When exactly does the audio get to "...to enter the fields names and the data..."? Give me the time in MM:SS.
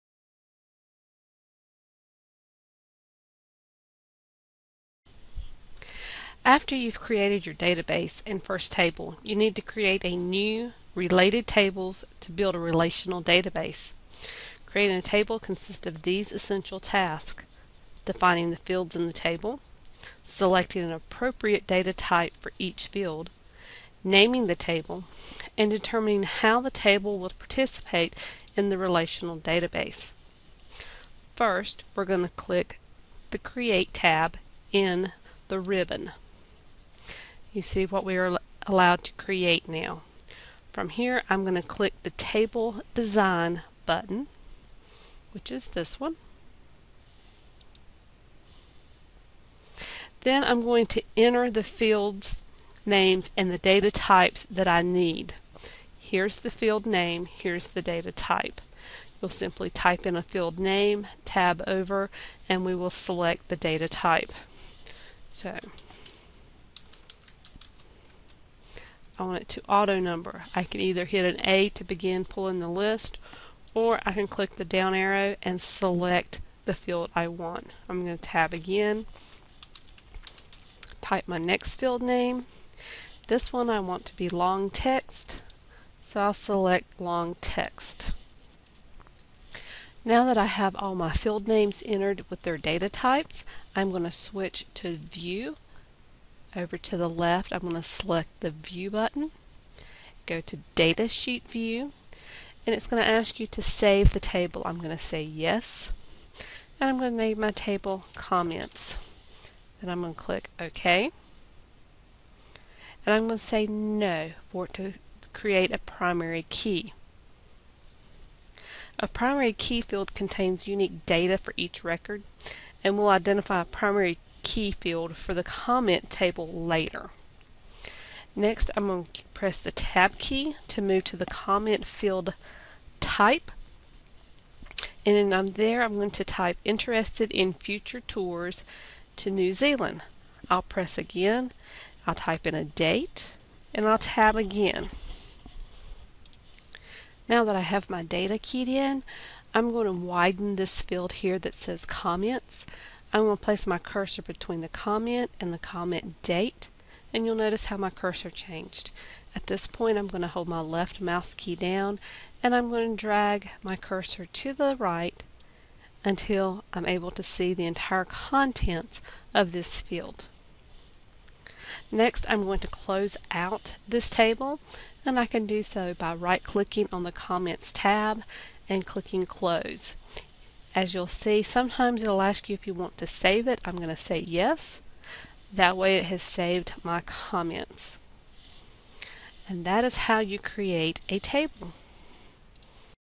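00:50.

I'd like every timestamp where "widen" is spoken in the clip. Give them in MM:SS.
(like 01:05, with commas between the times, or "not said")
02:29.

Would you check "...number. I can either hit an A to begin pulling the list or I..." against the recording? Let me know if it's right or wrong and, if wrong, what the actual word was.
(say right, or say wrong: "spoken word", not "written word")
right.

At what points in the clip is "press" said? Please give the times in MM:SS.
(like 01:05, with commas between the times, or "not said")
02:09, 02:20.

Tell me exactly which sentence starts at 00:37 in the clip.
You see what we are allowed to create now.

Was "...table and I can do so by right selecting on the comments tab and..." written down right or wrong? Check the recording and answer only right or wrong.
wrong.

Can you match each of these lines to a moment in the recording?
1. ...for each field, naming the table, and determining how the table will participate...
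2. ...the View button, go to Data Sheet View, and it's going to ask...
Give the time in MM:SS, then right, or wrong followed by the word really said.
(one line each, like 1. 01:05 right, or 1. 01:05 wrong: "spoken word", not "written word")
1. 00:22 right
2. 01:38 right.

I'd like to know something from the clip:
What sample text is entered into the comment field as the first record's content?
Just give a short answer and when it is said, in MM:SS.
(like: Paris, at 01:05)
Interested in future tours to New Zealand, at 02:16.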